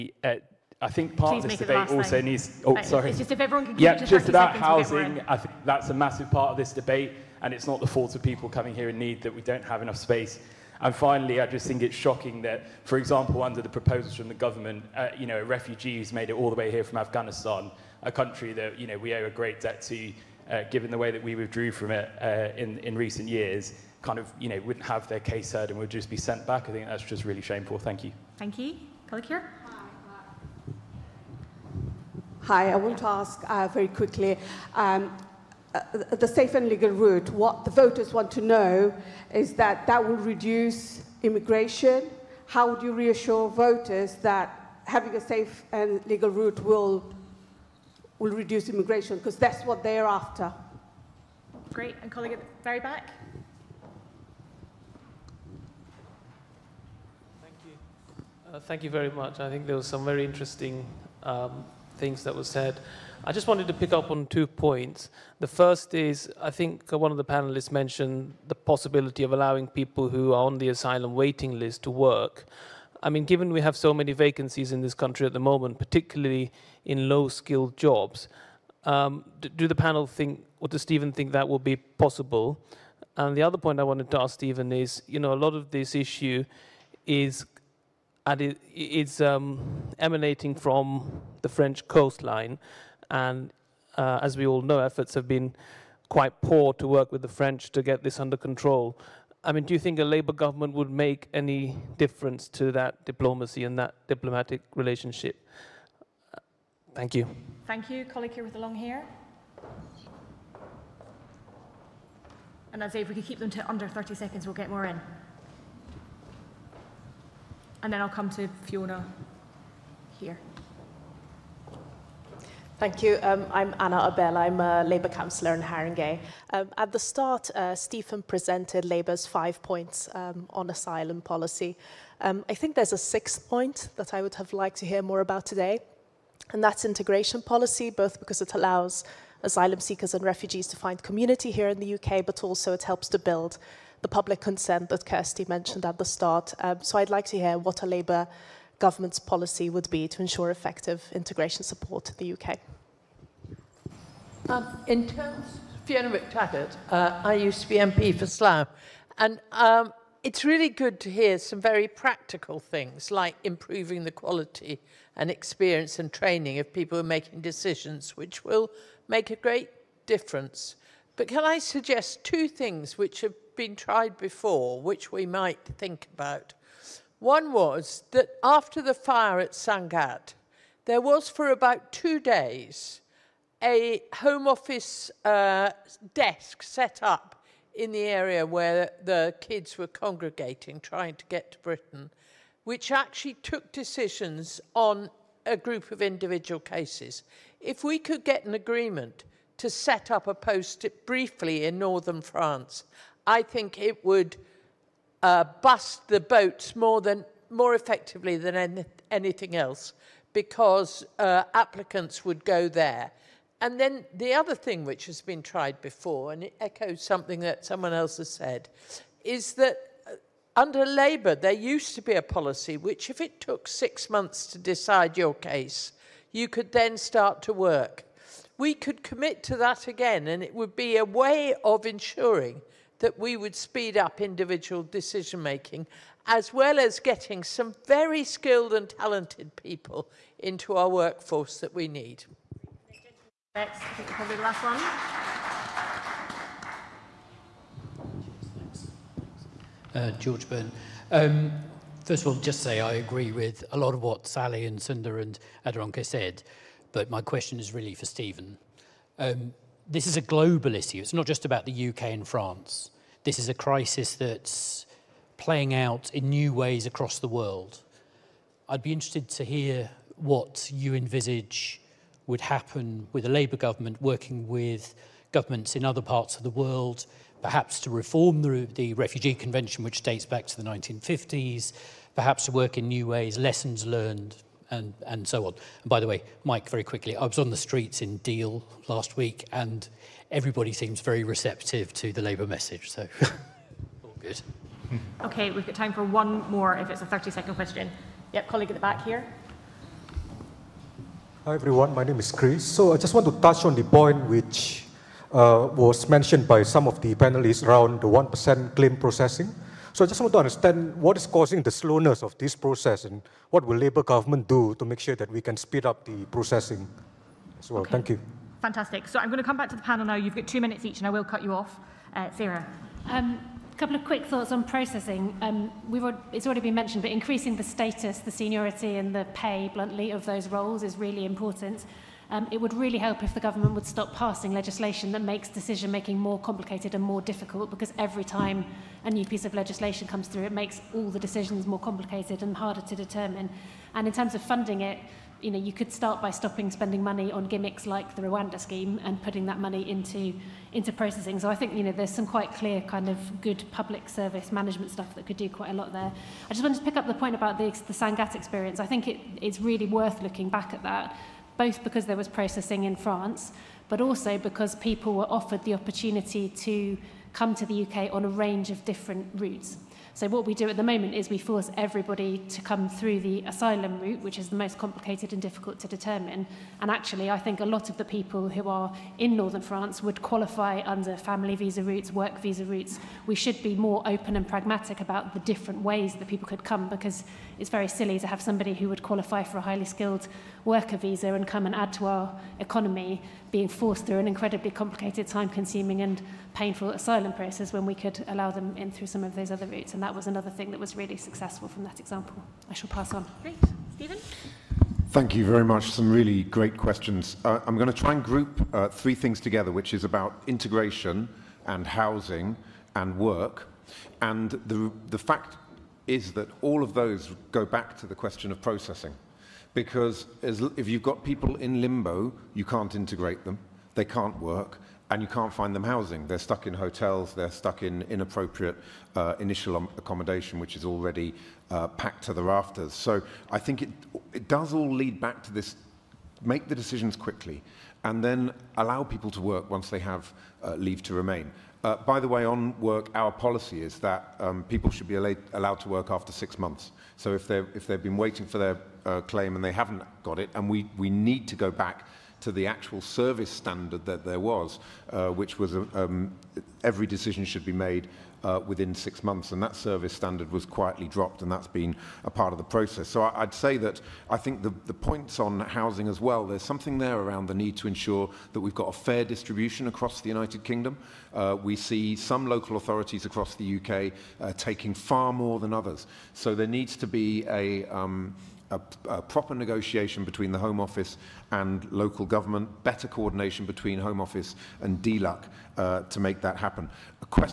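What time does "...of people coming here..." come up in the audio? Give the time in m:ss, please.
0:08.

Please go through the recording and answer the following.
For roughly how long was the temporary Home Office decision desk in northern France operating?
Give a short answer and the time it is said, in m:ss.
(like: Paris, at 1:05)
2 days, at 3:01.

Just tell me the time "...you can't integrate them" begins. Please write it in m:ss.
7:02.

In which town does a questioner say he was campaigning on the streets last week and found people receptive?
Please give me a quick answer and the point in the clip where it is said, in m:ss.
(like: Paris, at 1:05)
Deal, at 4:48.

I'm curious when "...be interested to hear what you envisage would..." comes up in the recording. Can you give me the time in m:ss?
4:28.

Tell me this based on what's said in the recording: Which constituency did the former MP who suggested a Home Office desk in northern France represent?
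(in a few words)
Slough.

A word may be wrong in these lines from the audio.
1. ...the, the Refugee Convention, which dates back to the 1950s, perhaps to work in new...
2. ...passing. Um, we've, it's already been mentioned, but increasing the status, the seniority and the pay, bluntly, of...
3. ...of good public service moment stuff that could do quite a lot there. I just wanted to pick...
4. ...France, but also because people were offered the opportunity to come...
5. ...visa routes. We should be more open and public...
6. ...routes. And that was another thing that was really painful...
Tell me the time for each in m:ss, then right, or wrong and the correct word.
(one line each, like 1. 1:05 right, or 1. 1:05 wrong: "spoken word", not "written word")
1. 4:38 right
2. 5:24 wrong: "processing", not "passing"
3. 5:53 wrong: "management", not "moment"
4. 6:02 right
5. 6:22 wrong: "pragmatic", not "public"
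6. 6:39 wrong: "successful", not "painful".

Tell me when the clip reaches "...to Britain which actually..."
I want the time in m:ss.
3:11.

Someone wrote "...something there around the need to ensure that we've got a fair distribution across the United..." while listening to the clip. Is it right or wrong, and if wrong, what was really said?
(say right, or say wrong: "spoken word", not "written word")
right.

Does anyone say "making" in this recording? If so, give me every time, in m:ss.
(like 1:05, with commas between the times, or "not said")
2:47, 3:55, 5:35.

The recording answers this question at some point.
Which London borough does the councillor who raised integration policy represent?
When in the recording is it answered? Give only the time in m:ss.
2:05.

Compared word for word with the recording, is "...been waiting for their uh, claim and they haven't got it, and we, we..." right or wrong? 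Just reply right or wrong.
right.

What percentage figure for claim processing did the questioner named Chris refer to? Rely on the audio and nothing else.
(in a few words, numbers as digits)
1%.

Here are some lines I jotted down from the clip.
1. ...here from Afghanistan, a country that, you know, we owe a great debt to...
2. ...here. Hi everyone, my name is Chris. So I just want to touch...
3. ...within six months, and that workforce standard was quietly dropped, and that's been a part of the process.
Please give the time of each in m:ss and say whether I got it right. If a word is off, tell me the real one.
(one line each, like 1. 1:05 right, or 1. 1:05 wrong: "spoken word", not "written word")
1. 0:16 right
2. 4:59 right
3. 7:38 wrong: "service", not "workforce".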